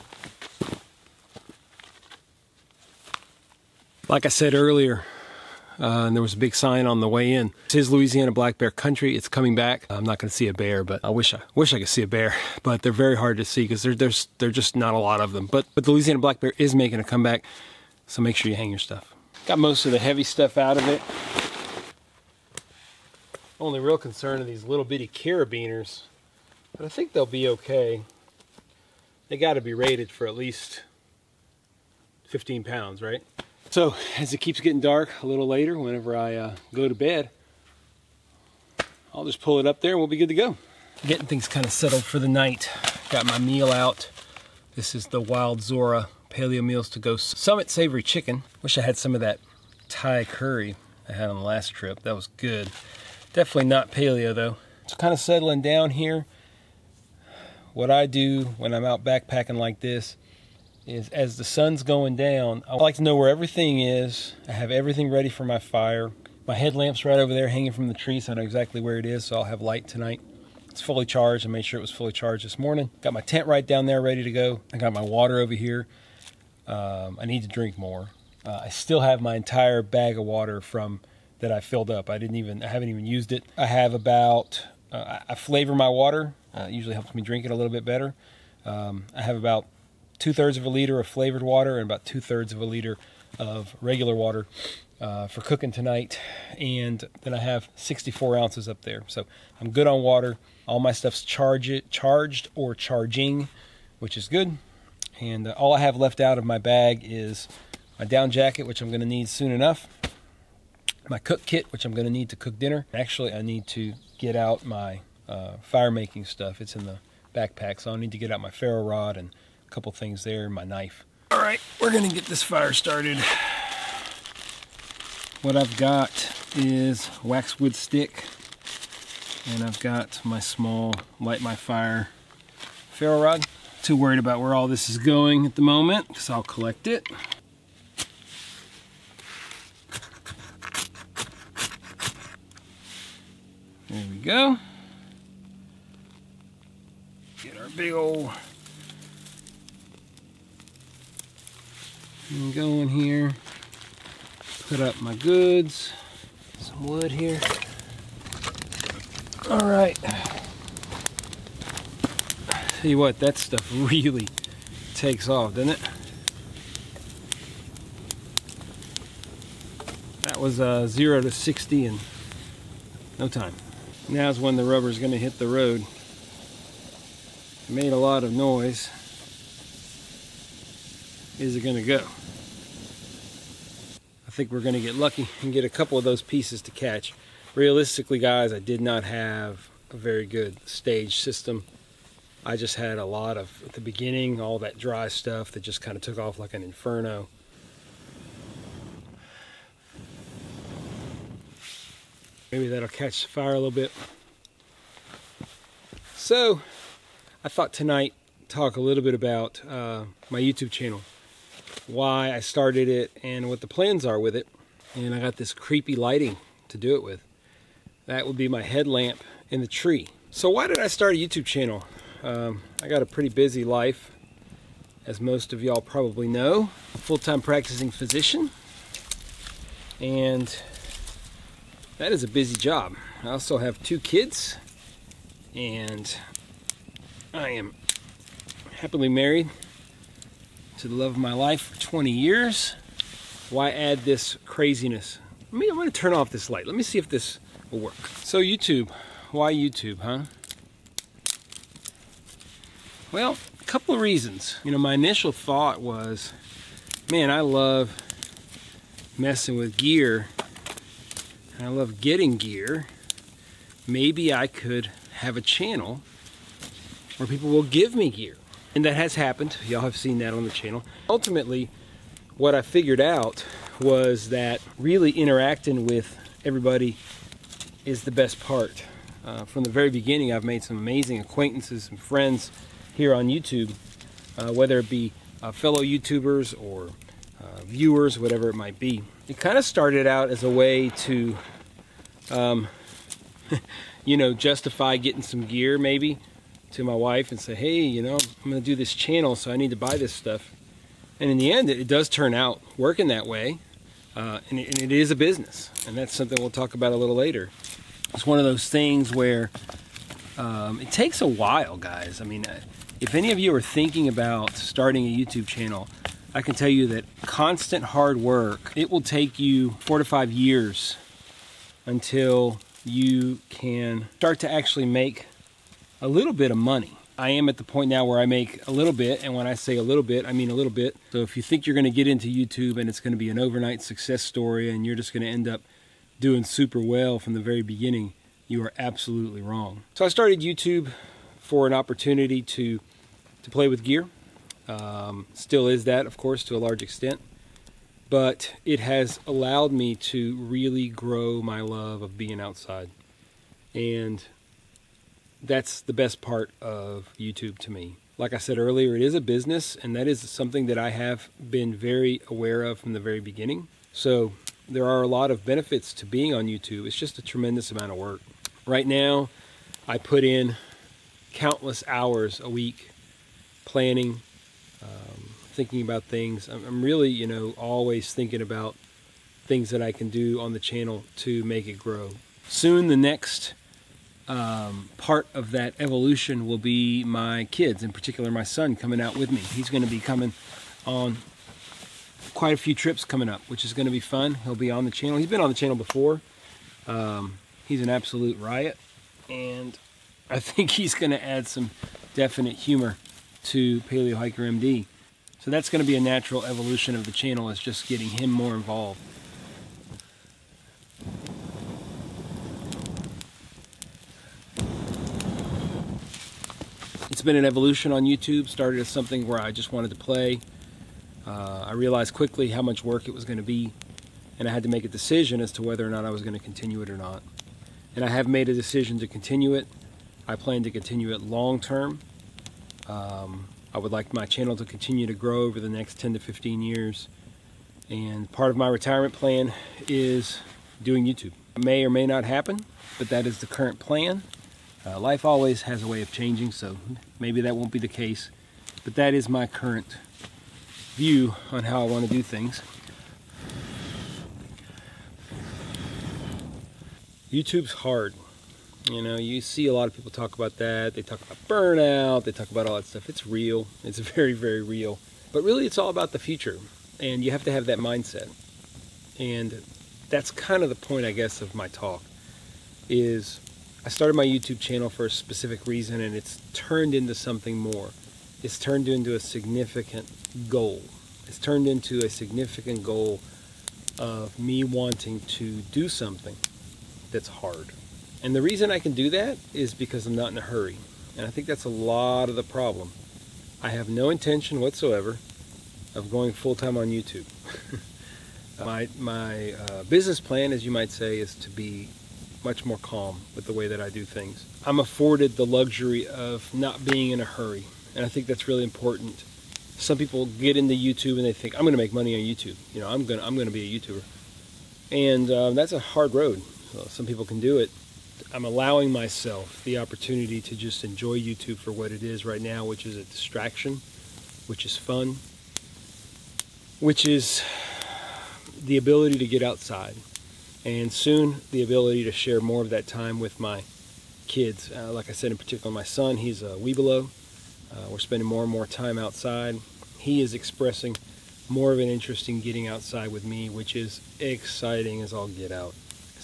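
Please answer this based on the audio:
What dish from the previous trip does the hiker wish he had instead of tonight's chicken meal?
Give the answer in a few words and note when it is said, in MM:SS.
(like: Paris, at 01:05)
Thai curry, at 00:49.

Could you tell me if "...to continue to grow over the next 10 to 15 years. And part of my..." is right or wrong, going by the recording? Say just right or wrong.
right.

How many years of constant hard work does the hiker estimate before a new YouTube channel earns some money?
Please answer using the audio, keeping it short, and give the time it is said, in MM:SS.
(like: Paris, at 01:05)
four to five years, at 05:19.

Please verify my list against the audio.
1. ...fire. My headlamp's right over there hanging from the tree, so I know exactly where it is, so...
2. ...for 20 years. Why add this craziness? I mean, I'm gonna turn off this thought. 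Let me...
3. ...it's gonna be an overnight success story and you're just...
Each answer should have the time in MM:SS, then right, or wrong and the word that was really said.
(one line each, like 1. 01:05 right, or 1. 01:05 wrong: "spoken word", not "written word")
1. 01:05 right
2. 04:01 wrong: "light", not "thought"
3. 05:32 right.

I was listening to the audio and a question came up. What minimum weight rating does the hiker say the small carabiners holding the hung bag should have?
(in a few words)
15 pounds.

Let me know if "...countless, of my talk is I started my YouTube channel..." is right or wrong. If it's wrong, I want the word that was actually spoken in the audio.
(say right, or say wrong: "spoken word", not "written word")
wrong: "guess", not "countless".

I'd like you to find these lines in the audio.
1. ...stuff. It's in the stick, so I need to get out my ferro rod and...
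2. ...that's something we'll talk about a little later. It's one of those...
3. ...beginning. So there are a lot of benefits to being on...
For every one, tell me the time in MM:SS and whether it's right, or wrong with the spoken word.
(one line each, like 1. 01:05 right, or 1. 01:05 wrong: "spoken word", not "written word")
1. 01:56 wrong: "backpack", not "stick"
2. 05:05 right
3. 06:03 right.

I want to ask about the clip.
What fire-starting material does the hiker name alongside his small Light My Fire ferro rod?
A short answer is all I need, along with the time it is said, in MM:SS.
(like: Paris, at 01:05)
wax wood stick, at 02:07.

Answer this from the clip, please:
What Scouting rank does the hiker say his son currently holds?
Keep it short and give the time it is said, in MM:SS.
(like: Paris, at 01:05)
Webelo, at 08:56.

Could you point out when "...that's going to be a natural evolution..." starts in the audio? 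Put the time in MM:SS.
06:45.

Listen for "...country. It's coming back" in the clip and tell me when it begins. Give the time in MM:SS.
00:08.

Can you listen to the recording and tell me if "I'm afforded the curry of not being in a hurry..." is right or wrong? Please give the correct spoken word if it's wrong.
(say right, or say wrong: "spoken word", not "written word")
wrong: "luxury", not "curry".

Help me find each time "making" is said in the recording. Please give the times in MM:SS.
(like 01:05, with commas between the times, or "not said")
00:16, 01:55.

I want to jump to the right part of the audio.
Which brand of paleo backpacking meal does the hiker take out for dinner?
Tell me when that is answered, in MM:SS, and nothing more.
00:45.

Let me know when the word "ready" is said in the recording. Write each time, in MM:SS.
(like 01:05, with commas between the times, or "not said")
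01:05, 01:14.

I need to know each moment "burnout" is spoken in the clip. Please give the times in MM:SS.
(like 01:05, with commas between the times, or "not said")
07:41.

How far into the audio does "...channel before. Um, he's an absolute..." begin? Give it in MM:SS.
06:35.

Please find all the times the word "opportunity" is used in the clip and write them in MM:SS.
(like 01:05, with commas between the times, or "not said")
05:41, 08:39.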